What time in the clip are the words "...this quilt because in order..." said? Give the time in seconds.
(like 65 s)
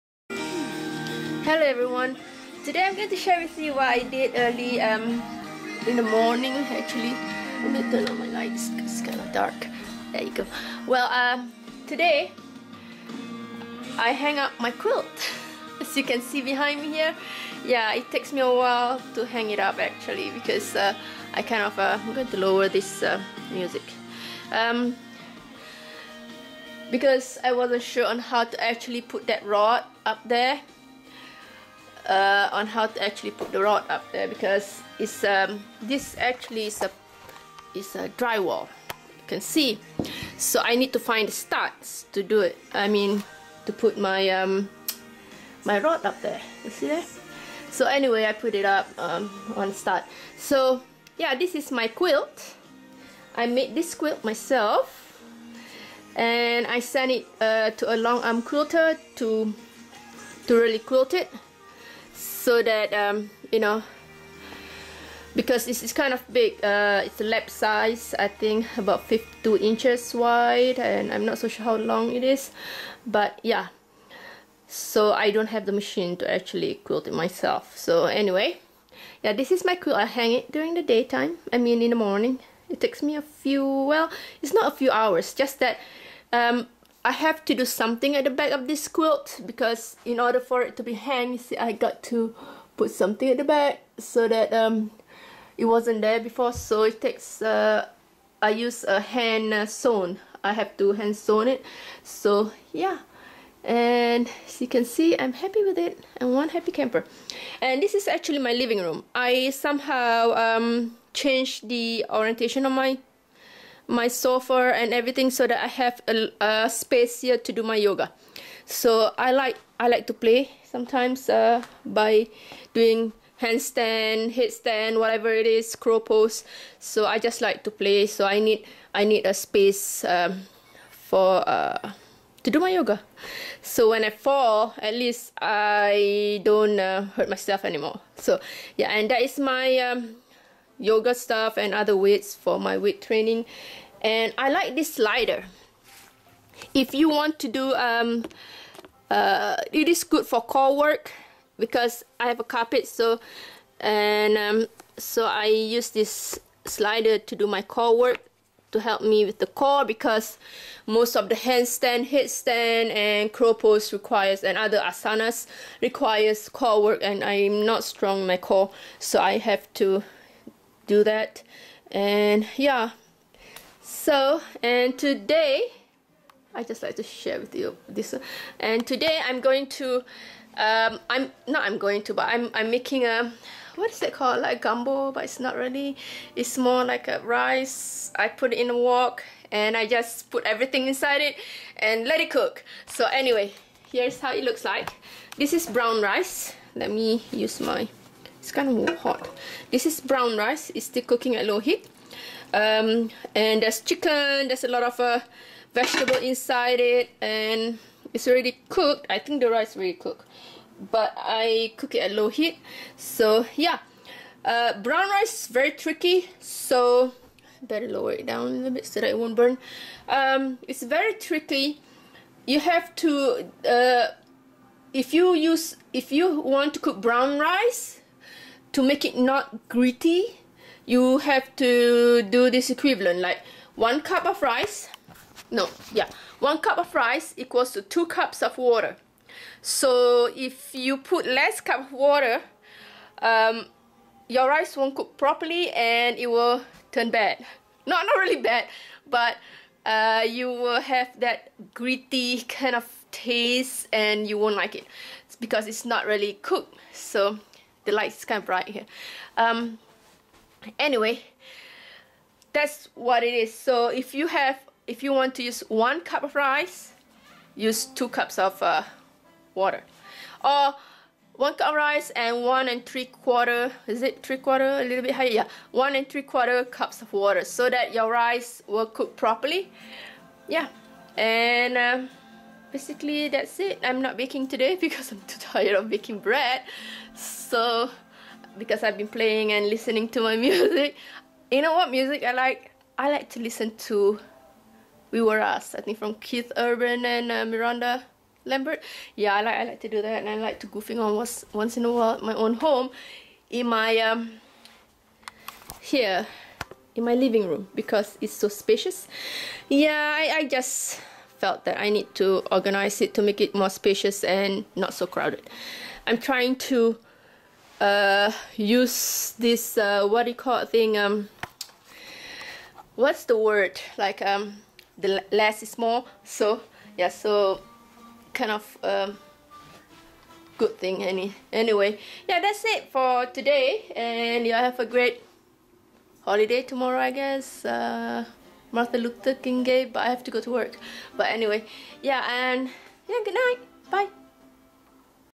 88 s.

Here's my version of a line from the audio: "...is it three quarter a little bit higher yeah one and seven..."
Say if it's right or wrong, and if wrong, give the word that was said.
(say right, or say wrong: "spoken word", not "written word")
wrong: "three", not "seven".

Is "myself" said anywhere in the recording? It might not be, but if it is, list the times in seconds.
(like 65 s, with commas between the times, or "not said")
54 s, 77 s, 137 s.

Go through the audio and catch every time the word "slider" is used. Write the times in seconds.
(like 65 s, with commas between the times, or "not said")
144 s, 156 s.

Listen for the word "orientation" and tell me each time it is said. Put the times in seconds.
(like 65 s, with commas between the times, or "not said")
112 s.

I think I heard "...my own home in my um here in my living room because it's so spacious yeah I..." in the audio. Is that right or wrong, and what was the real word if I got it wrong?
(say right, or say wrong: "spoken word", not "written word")
right.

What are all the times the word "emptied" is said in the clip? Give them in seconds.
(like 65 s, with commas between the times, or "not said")
not said.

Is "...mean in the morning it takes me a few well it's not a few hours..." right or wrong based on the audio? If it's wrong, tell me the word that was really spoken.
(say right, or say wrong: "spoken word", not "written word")
right.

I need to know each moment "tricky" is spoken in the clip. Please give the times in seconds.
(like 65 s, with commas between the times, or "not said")
215 s, 221 s.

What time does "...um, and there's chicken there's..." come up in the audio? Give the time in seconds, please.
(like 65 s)
202 s.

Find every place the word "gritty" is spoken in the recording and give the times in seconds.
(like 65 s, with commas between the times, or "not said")
229 s, 251 s.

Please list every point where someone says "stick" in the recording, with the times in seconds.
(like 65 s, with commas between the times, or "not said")
not said.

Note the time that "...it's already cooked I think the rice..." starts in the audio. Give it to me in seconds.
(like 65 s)
208 s.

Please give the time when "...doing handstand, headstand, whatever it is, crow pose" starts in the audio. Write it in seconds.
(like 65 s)
122 s.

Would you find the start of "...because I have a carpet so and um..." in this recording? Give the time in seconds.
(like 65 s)
151 s.